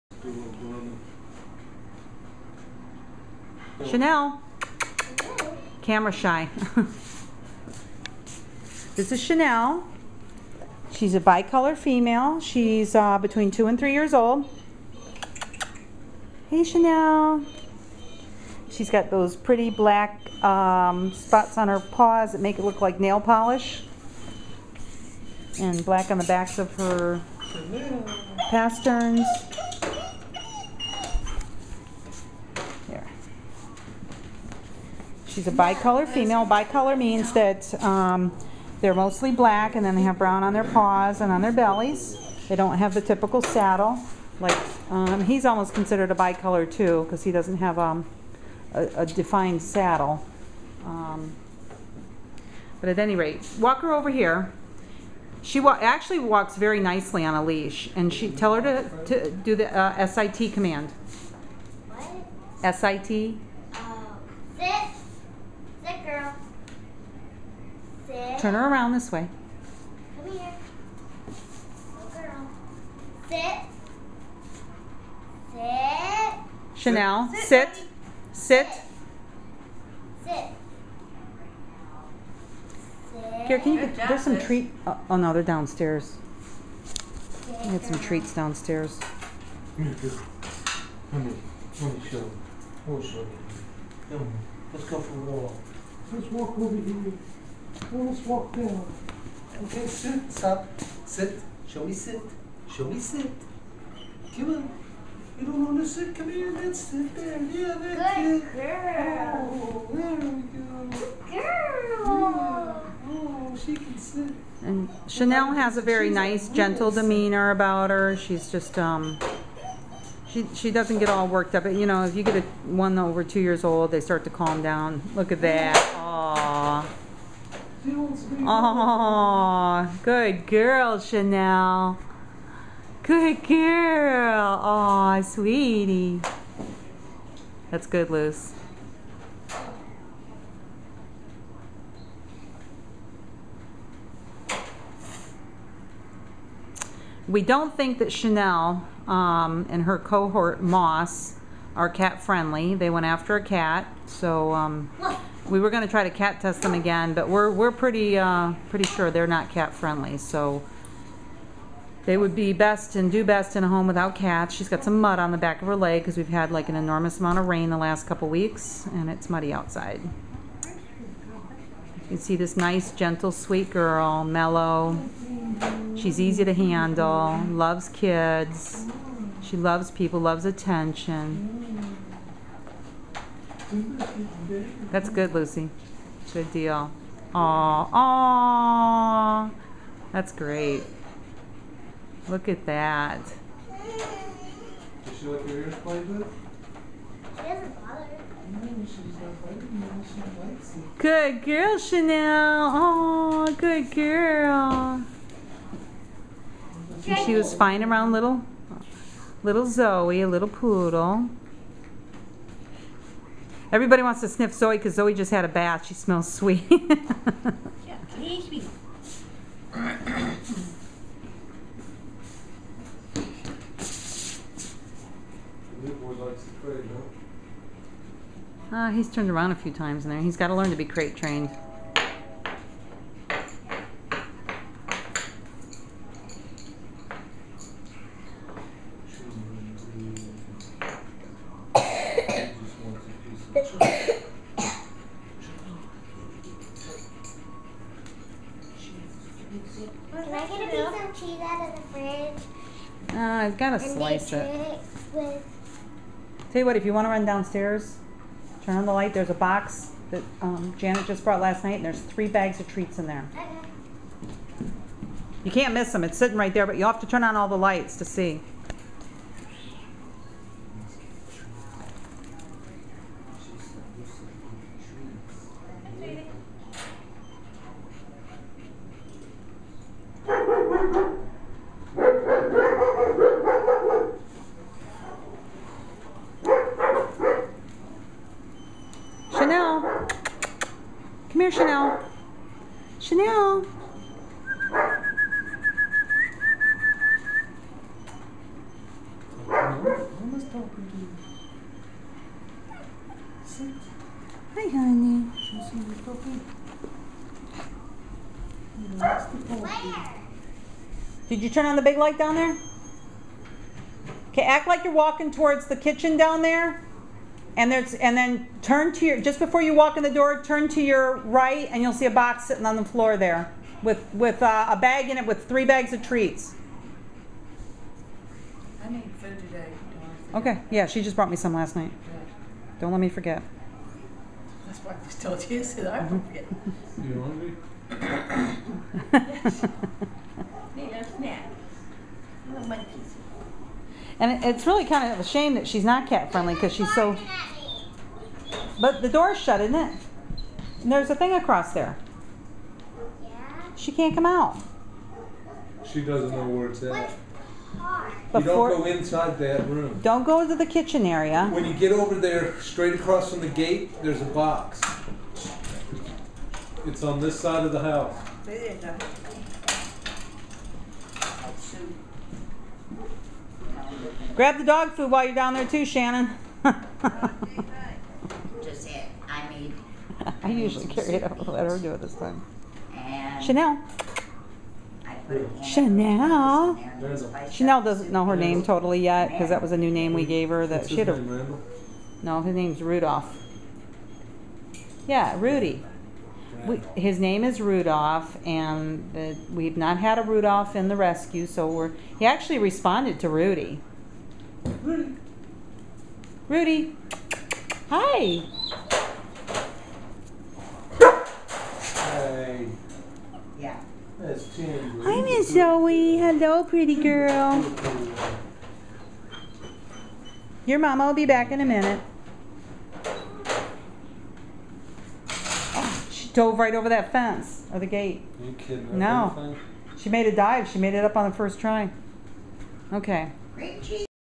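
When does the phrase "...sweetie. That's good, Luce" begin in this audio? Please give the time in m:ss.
2:15.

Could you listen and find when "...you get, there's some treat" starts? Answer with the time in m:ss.
1:23.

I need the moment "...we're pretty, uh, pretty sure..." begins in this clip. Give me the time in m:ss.
2:37.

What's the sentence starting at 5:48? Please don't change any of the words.
But the door's shut, isn't it?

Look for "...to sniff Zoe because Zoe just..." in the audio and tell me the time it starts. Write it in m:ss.
3:34.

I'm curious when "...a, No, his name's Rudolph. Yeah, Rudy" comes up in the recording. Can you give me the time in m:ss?
6:31.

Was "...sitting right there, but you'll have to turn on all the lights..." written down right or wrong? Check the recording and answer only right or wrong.
right.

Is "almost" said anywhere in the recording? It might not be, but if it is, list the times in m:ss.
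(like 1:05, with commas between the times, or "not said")
0:45, 1:37.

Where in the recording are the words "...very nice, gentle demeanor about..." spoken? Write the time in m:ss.
1:55.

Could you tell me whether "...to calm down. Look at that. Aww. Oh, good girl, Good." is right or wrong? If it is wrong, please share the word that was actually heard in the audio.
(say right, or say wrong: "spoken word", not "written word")
wrong: "Chanel", not "Good".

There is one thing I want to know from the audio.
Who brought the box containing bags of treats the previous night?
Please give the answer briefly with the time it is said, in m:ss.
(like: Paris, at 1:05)
Janet, at 4:20.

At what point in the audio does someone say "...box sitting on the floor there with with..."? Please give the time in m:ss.
5:22.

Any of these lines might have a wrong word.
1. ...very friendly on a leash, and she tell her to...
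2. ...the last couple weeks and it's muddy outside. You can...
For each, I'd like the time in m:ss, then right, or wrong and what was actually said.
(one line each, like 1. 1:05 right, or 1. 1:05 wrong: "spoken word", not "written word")
1. 0:56 wrong: "nicely", not "friendly"
2. 2:47 right.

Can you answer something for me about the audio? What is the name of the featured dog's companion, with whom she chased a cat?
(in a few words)
Moss.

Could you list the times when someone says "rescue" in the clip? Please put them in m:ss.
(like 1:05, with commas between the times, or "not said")
6:40.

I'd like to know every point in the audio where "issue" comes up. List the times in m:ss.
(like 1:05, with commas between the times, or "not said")
not said.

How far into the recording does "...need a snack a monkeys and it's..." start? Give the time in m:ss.
5:40.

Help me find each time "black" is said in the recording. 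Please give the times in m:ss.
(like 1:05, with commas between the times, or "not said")
0:19, 0:25, 0:39.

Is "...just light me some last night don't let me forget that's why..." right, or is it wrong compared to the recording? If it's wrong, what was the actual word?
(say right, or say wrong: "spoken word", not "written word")
wrong: "brought", not "light".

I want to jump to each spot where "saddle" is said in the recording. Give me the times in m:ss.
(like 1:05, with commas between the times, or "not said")
0:43, 0:49.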